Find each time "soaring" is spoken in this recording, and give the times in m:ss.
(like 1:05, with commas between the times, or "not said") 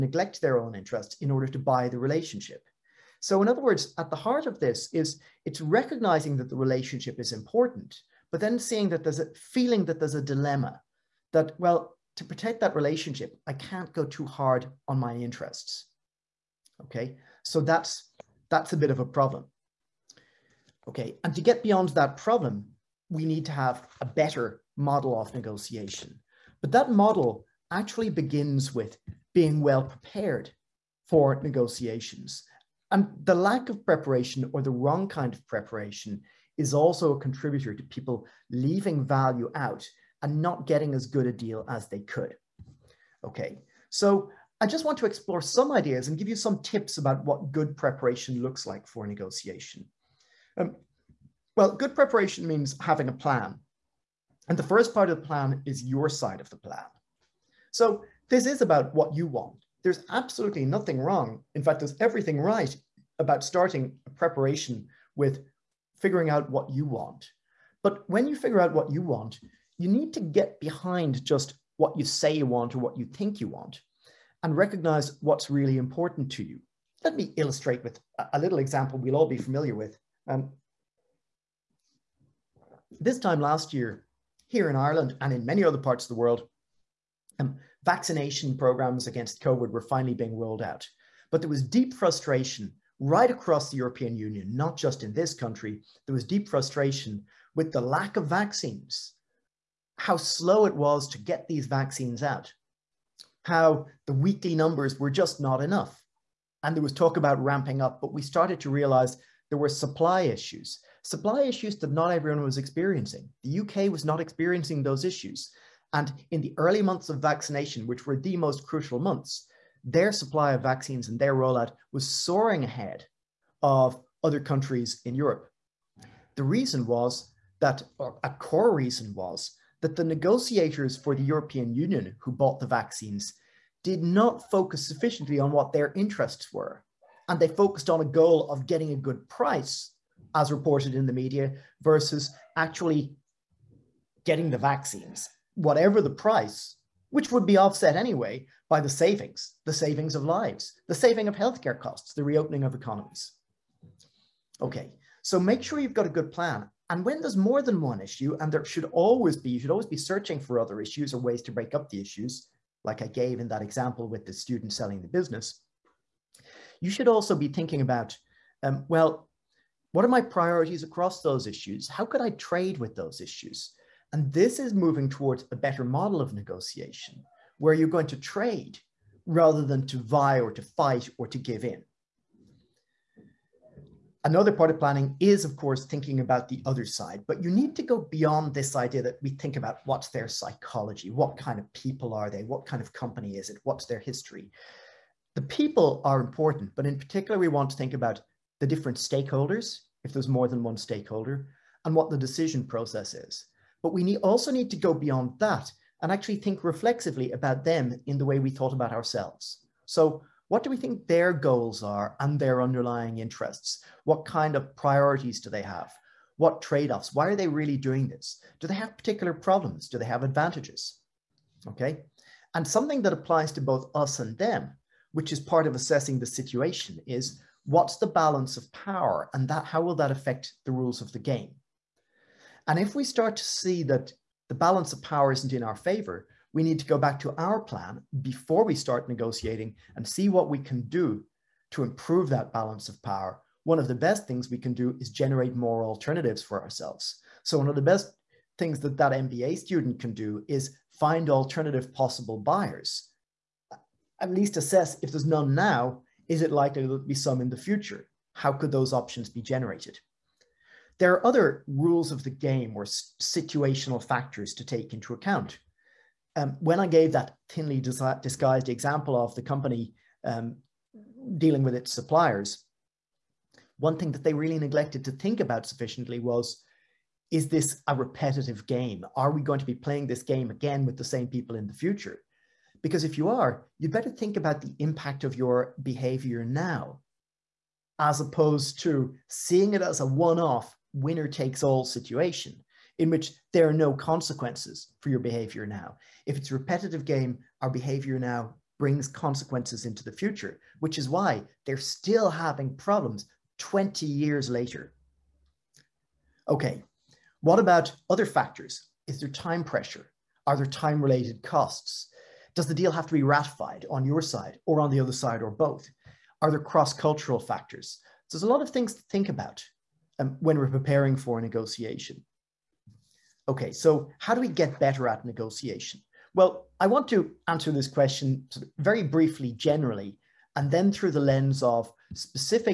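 2:02.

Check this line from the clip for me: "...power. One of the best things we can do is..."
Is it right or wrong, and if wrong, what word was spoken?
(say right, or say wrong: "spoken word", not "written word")
right.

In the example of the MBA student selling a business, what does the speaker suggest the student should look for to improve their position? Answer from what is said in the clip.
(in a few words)
alternative possible buyers.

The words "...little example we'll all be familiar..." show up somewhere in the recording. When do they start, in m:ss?
1:18.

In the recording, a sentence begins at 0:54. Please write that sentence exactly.
And the first part of the plan is your side of the plan.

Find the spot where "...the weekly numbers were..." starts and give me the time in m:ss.
1:44.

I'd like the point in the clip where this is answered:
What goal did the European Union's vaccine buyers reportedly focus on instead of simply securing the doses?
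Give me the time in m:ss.
2:18.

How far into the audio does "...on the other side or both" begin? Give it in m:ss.
5:14.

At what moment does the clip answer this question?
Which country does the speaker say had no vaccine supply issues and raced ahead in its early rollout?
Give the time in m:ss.
1:53.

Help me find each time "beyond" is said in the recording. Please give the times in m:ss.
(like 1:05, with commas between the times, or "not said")
0:21, 3:08, 3:24.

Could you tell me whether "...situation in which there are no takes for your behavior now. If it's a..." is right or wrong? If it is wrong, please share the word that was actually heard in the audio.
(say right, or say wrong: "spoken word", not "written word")
wrong: "consequences", not "takes".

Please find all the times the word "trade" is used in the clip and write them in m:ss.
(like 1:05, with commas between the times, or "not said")
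2:52, 2:58, 3:36.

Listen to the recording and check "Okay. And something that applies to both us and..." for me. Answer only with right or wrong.
right.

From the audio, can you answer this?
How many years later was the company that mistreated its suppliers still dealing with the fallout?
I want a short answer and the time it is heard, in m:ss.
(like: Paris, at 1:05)
20 years, at 5:03.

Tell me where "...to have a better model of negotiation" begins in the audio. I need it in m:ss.
0:23.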